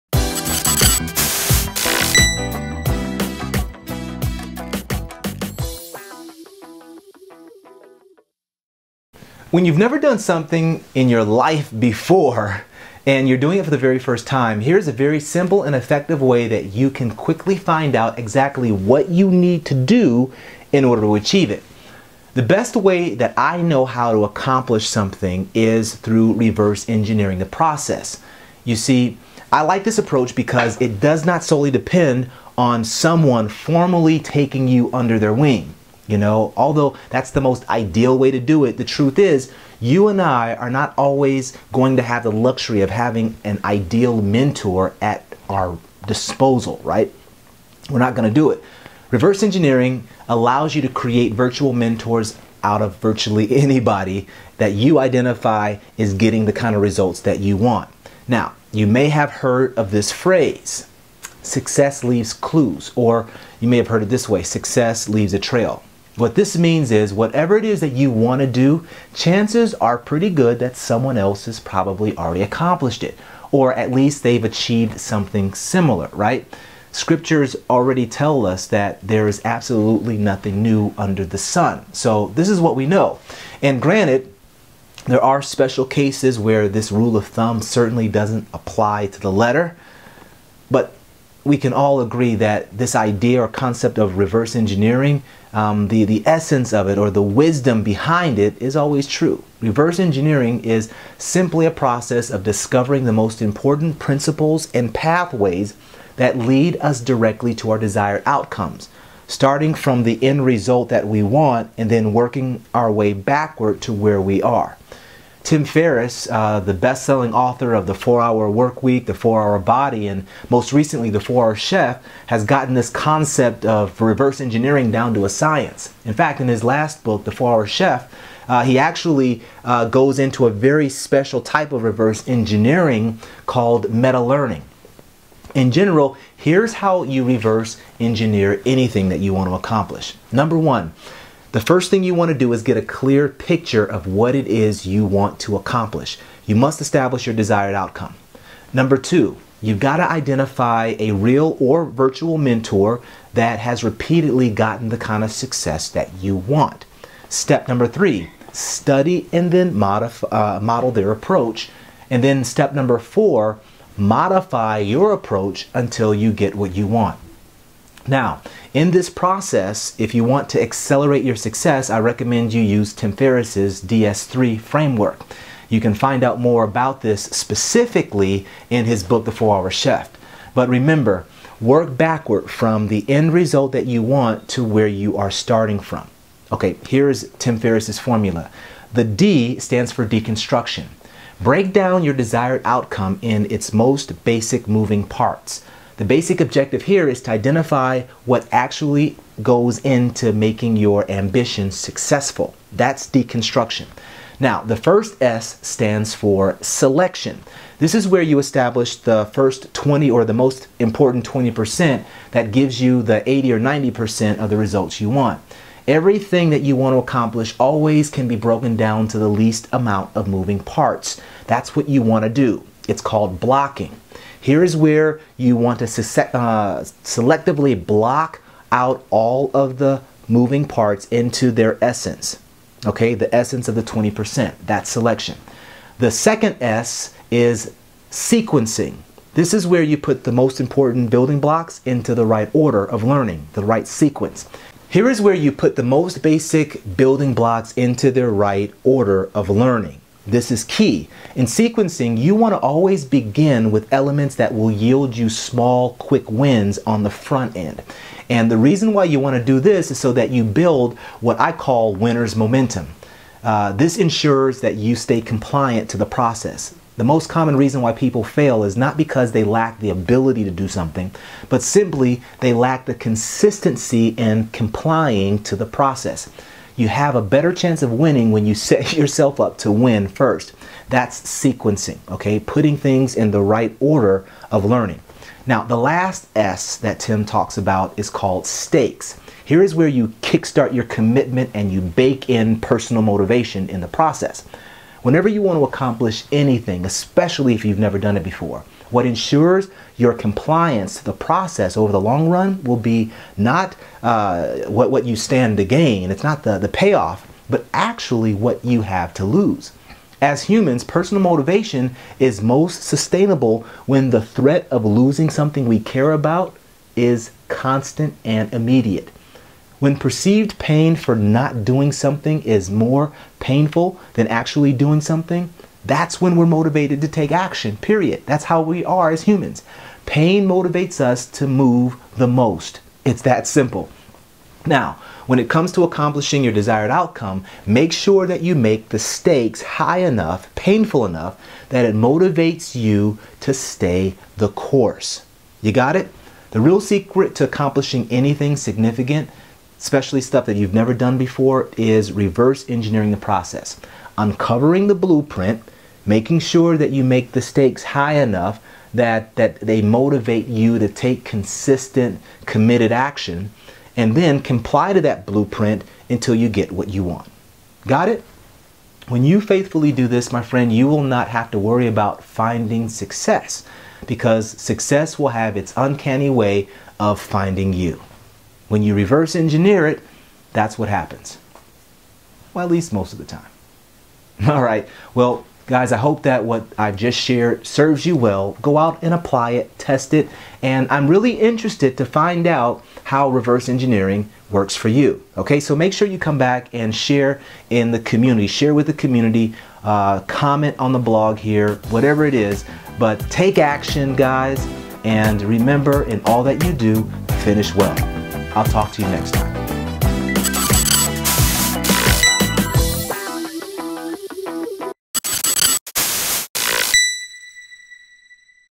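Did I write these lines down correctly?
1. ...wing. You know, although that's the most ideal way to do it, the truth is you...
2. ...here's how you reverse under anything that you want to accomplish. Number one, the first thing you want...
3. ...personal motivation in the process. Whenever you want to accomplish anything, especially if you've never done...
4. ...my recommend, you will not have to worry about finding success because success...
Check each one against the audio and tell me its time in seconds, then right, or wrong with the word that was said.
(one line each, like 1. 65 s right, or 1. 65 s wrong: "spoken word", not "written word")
1. 35 s right
2. 136 s wrong: "engineer", not "under"
3. 292 s right
4. 370 s wrong: "friend", not "recommend".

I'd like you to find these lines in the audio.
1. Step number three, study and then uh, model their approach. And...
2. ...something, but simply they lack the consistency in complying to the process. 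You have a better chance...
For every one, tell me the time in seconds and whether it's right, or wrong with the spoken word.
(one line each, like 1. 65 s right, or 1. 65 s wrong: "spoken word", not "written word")
1. 157 s right
2. 270 s right.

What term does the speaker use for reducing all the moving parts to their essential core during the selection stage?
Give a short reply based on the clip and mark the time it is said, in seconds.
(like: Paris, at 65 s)
Blocking, at 223 s.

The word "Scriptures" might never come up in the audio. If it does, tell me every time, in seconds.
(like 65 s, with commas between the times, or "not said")
76 s.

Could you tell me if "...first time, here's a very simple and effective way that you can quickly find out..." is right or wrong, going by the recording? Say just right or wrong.
right.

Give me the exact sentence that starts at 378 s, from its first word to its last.
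When you reverse engineer it, that's what happens.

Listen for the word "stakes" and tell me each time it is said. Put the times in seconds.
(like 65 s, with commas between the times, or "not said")
288 s, 338 s, 357 s.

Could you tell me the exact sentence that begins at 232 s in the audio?
Okay, the essence of the 20%, that selection.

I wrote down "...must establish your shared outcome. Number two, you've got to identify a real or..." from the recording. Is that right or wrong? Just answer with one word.
wrong.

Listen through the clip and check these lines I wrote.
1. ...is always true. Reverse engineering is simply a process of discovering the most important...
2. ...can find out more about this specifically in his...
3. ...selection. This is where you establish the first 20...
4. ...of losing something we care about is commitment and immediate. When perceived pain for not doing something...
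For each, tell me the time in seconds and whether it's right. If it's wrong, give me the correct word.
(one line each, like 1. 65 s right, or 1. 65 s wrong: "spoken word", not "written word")
1. 98 s right
2. 175 s right
3. 206 s right
4. 314 s wrong: "constant", not "commitment".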